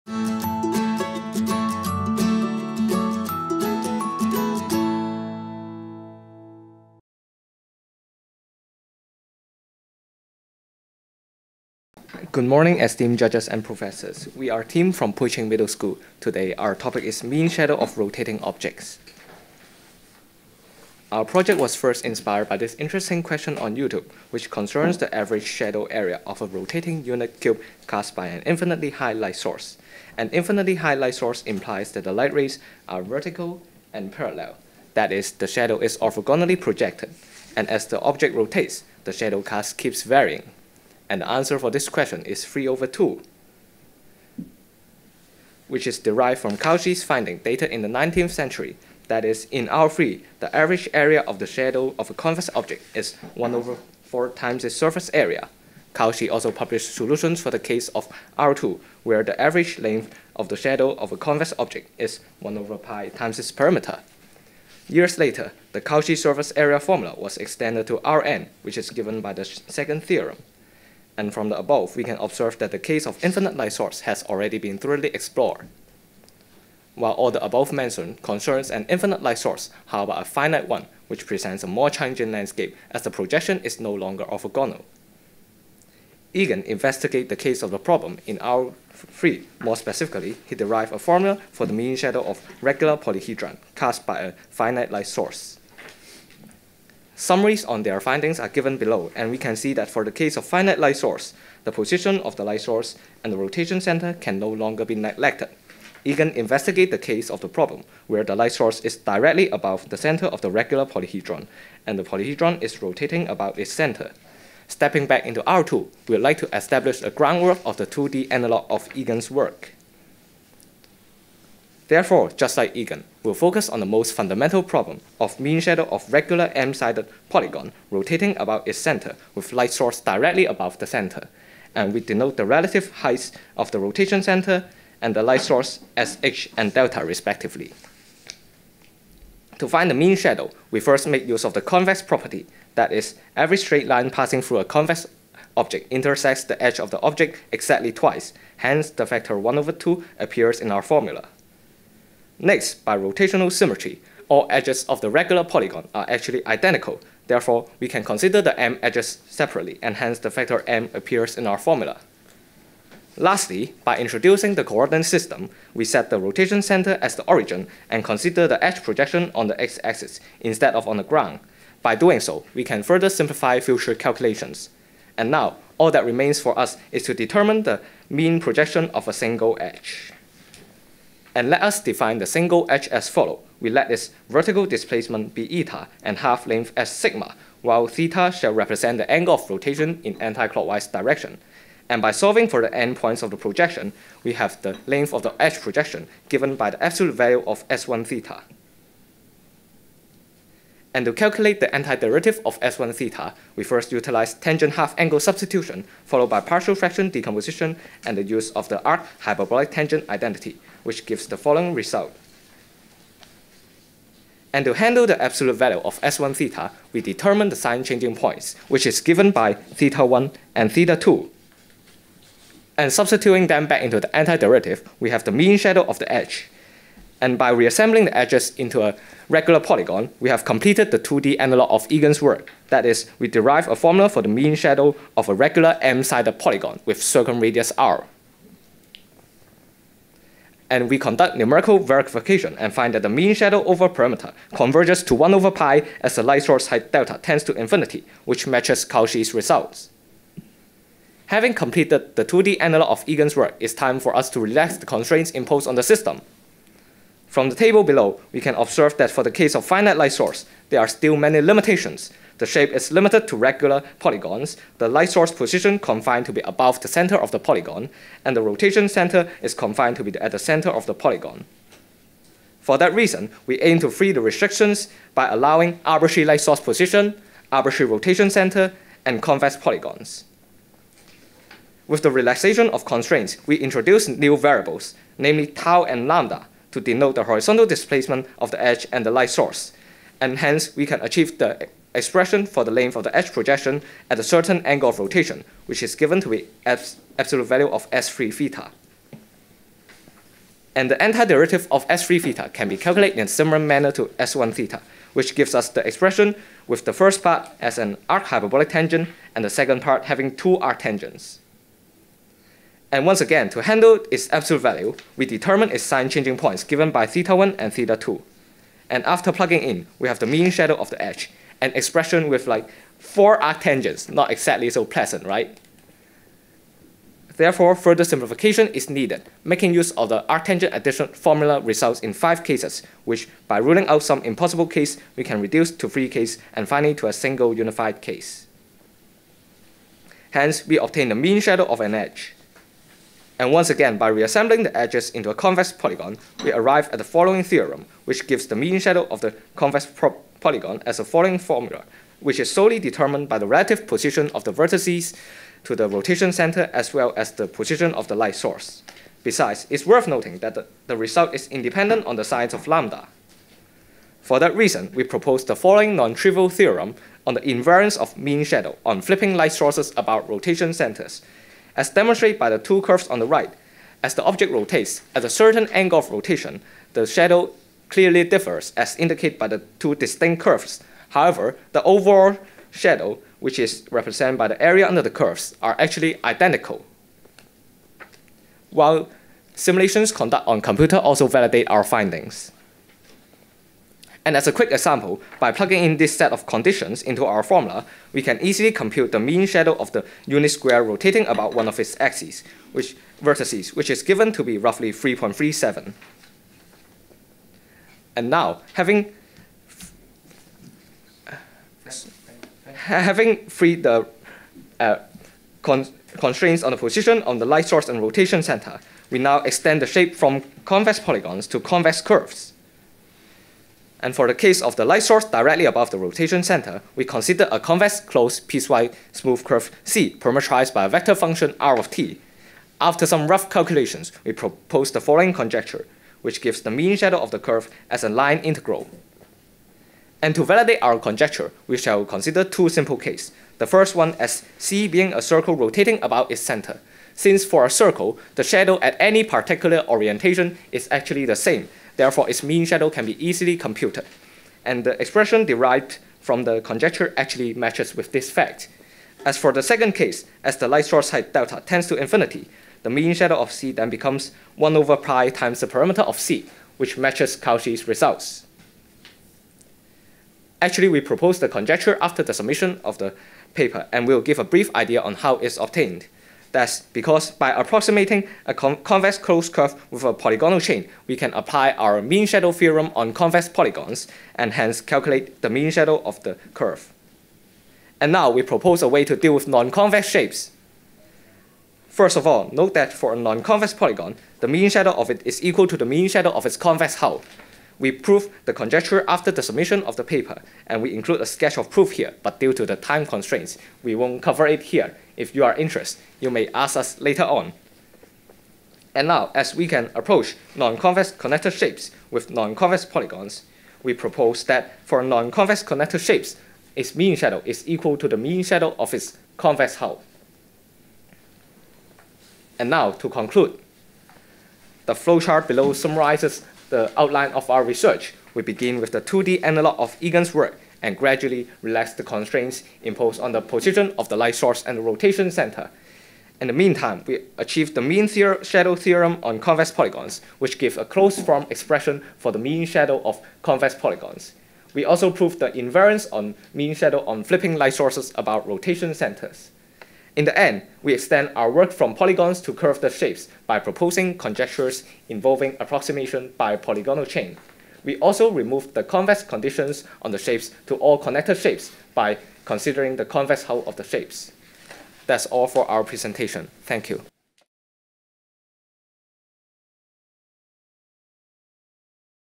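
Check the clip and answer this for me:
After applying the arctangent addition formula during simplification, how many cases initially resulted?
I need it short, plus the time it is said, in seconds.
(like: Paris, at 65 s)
5, at 332 s.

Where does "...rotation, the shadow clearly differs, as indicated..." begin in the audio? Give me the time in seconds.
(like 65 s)
376 s.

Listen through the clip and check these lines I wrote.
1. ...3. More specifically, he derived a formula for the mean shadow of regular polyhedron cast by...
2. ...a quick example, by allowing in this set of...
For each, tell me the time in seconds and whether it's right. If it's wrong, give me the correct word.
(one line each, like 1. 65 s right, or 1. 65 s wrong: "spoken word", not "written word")
1. 88 s right
2. 394 s wrong: "plugging", not "allowing".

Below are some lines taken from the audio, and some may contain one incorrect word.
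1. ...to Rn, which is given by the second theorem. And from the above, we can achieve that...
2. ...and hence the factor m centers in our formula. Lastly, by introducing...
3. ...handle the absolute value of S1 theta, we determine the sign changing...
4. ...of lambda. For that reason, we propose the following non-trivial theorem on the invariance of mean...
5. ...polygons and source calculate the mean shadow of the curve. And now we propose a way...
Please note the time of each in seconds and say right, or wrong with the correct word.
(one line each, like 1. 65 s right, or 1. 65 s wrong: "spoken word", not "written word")
1. 67 s wrong: "observe", not "achieve"
2. 159 s wrong: "appears", not "centers"
3. 214 s right
4. 362 s right
5. 483 s wrong: "hence", not "source".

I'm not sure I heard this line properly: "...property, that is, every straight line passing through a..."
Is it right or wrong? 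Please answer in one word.
right.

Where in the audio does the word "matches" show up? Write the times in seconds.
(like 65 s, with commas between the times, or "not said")
248 s, 457 s, 466 s.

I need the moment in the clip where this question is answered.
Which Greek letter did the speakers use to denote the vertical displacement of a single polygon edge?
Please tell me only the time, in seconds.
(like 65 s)
185 s.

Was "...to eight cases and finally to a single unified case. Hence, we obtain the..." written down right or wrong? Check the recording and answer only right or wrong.
wrong.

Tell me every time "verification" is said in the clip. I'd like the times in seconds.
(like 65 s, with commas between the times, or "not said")
241 s.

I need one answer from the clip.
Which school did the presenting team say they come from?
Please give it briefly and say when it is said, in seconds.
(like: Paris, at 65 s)
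Pui Ching Middle School, at 15 s.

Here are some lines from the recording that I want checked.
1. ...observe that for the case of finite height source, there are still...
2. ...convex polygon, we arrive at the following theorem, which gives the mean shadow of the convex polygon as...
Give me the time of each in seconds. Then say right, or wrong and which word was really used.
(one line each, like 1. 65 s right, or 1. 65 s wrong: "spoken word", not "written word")
1. 258 s wrong: "light", not "height"
2. 345 s right.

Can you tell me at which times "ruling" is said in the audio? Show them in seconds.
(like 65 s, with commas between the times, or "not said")
333 s.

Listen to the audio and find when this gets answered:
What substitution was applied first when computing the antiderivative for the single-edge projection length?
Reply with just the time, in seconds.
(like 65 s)
204 s.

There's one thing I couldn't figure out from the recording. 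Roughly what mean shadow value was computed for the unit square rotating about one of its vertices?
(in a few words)
3.37.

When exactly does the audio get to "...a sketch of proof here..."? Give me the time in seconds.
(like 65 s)
501 s.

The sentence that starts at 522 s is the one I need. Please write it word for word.
And now, to conclude, the flowchart below summarizes the outline of our research.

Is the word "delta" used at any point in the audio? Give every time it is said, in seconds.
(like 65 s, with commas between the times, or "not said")
136 s, 246 s, 461 s.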